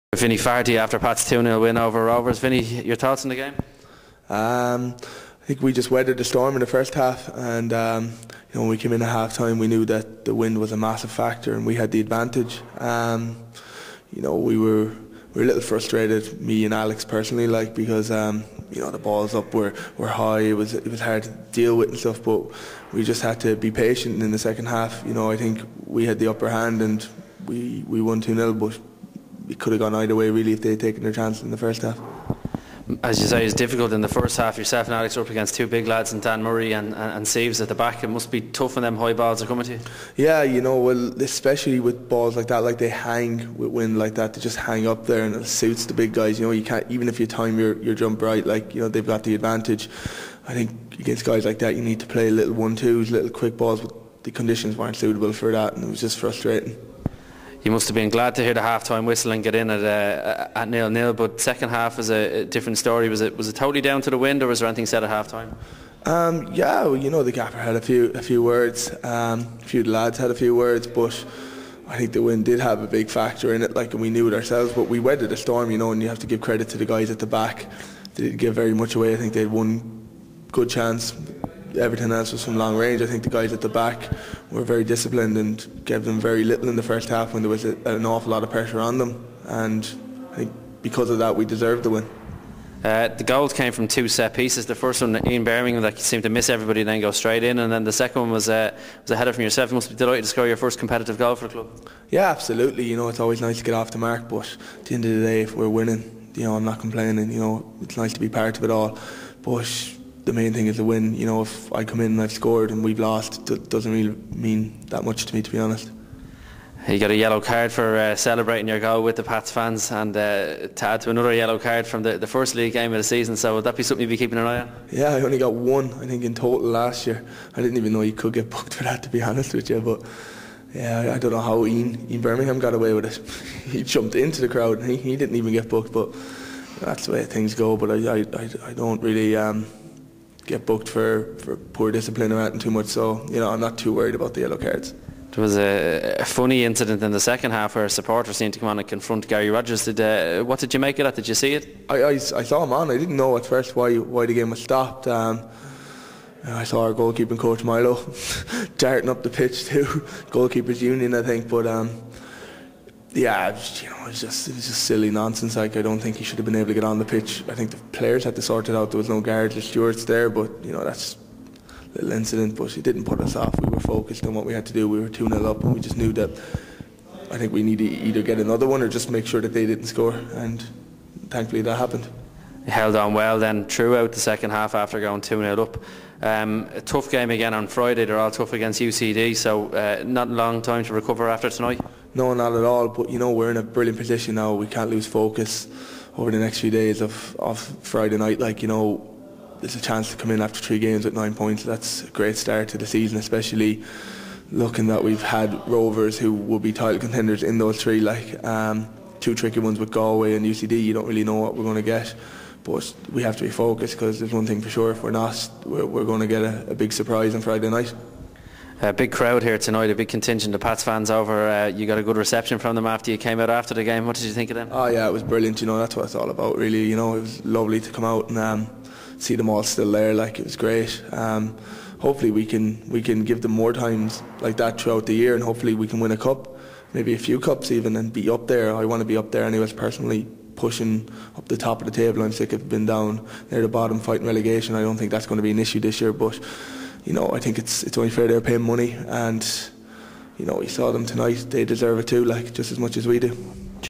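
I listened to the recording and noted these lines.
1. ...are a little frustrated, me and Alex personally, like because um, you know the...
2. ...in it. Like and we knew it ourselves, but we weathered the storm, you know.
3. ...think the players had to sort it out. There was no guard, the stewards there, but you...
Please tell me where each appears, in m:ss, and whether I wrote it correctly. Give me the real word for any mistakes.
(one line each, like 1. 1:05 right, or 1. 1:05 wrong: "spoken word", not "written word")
1. 0:15 right
2. 1:13 right
3. 2:47 right.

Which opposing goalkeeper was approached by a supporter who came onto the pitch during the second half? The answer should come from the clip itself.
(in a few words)
Gary Rogers.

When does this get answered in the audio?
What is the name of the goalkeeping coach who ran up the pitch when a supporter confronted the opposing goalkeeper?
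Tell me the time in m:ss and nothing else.
2:37.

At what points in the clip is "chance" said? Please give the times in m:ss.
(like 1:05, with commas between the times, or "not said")
0:31, 1:20, 3:19.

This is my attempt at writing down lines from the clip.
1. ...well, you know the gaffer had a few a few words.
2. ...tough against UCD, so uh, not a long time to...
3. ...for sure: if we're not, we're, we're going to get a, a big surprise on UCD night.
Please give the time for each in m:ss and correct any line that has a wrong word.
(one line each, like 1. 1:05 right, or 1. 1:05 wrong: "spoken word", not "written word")
1. 1:06 right
2. 3:08 right
3. 3:34 wrong: "Friday", not "UCD".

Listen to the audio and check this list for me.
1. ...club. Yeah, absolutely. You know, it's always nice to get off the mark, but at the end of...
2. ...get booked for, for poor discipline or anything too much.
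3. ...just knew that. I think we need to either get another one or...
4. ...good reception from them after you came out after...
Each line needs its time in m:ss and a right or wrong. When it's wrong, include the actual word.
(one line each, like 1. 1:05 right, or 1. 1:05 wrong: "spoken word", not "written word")
1. 1:41 right
2. 2:20 right
3. 2:55 right
4. 3:42 right.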